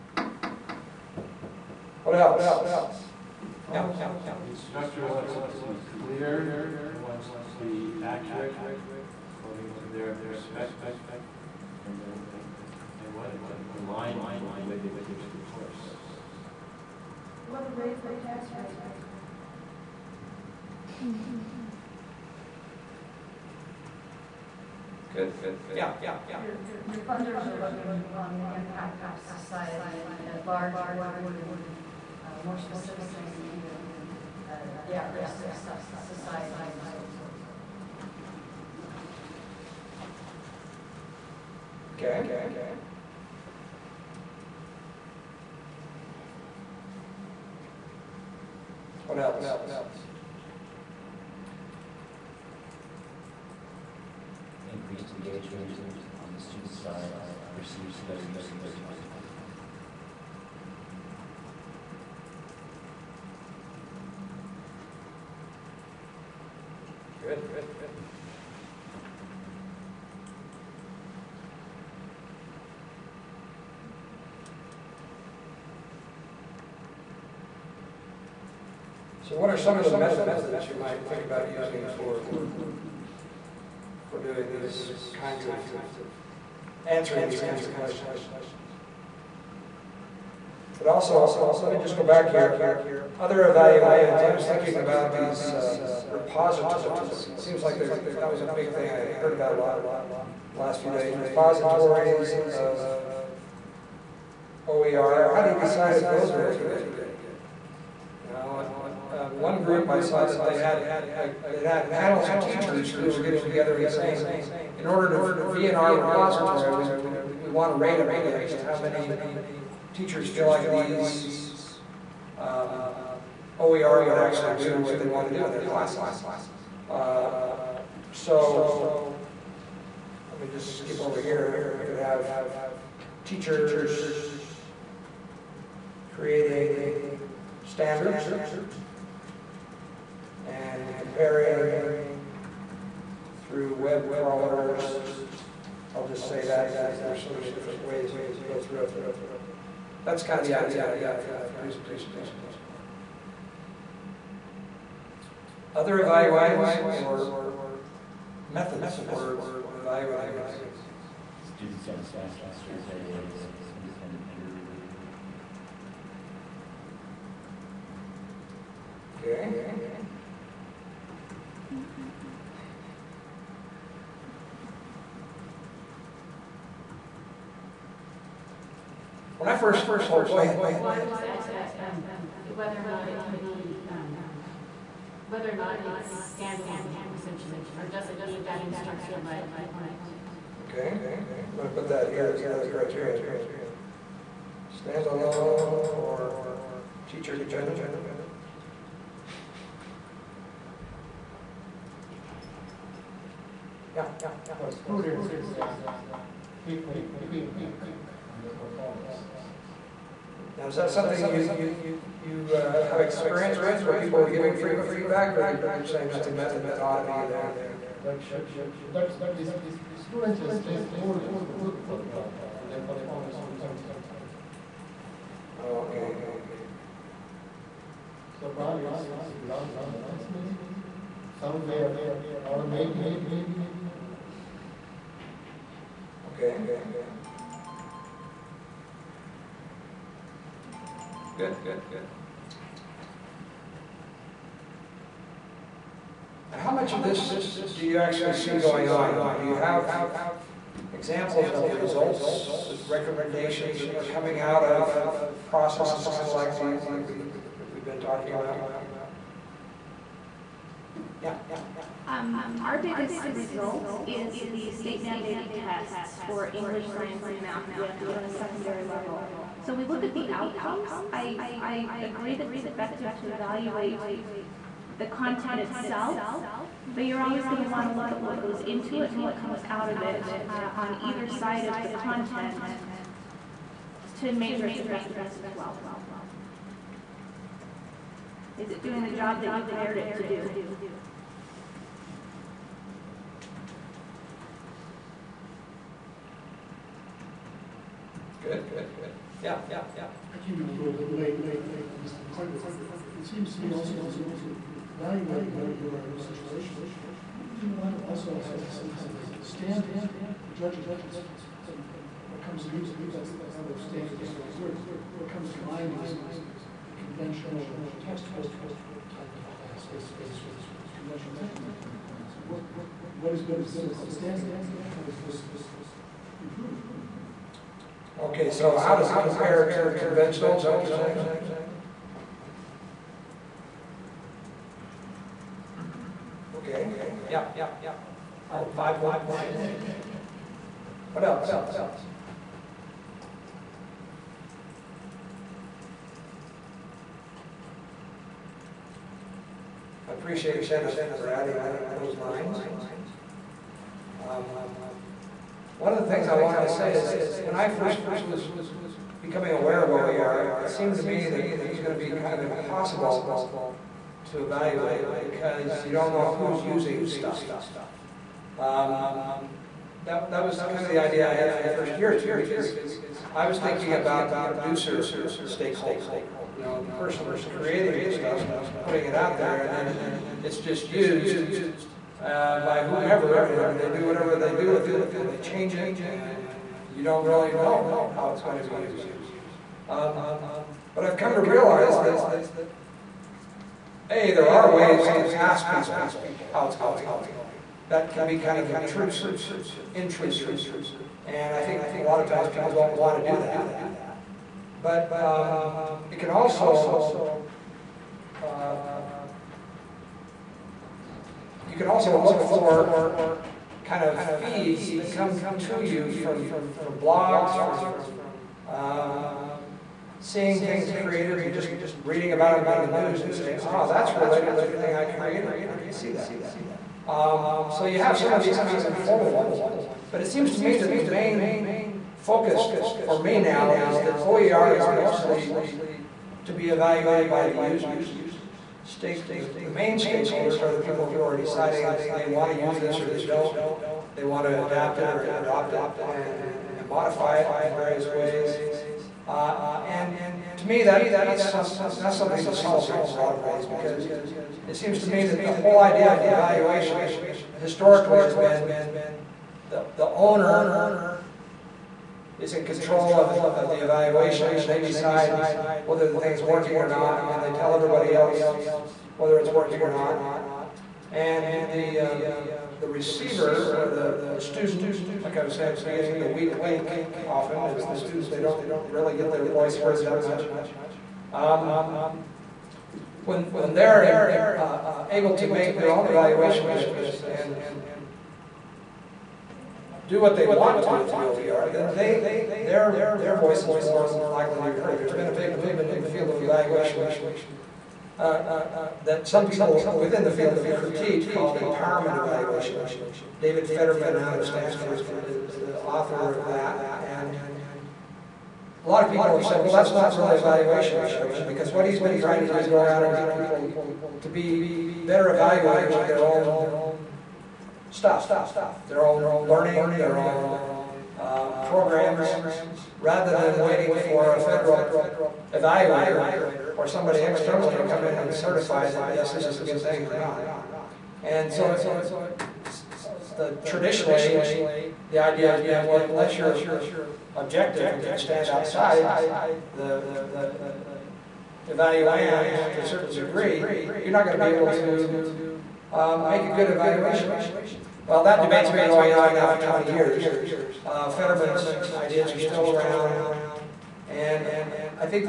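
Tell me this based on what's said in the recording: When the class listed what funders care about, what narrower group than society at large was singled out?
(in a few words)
at-risk society.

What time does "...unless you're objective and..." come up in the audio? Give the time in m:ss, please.
8:56.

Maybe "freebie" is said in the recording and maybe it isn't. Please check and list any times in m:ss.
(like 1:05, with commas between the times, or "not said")
not said.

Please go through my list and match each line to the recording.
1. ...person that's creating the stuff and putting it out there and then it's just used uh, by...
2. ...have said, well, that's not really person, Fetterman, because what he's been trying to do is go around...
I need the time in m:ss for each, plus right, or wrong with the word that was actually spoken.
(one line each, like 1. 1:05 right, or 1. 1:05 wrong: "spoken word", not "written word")
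1. 6:16 right
2. 8:29 wrong: "evaluation", not "person".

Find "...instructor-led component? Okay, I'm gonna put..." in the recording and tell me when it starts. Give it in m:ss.
3:08.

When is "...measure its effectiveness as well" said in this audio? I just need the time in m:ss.
4:44.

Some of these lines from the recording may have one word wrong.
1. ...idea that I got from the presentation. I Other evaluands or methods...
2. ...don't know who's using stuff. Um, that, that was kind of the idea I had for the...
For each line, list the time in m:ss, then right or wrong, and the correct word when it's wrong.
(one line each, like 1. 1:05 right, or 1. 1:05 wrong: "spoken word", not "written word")
1. 2:30 right
2. 6:05 right.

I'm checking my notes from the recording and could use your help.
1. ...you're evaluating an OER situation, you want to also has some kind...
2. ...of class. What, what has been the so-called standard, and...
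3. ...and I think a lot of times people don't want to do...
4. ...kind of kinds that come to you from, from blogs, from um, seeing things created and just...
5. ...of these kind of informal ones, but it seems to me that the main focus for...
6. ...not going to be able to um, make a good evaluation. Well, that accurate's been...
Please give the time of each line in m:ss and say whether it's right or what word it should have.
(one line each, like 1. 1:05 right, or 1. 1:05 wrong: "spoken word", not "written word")
1. 5:04 right
2. 5:21 right
3. 6:41 right
4. 6:53 wrong: "feeds", not "kinds"
5. 7:08 right
6. 9:04 wrong: "debate", not "accurate".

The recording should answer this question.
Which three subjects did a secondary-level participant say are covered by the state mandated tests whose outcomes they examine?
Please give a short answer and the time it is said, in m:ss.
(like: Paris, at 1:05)
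English, science, and math, at 4:26.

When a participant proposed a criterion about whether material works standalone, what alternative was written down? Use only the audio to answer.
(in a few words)
teacher-dependent.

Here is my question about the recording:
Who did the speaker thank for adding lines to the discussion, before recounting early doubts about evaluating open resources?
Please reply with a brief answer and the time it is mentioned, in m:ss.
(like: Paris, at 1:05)
Zenith, at 5:50.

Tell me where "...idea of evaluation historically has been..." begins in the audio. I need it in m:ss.
7:35.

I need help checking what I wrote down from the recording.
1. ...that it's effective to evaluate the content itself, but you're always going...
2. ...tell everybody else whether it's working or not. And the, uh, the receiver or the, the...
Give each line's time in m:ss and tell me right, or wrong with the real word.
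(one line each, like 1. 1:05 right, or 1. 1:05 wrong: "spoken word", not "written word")
1. 4:32 right
2. 7:47 right.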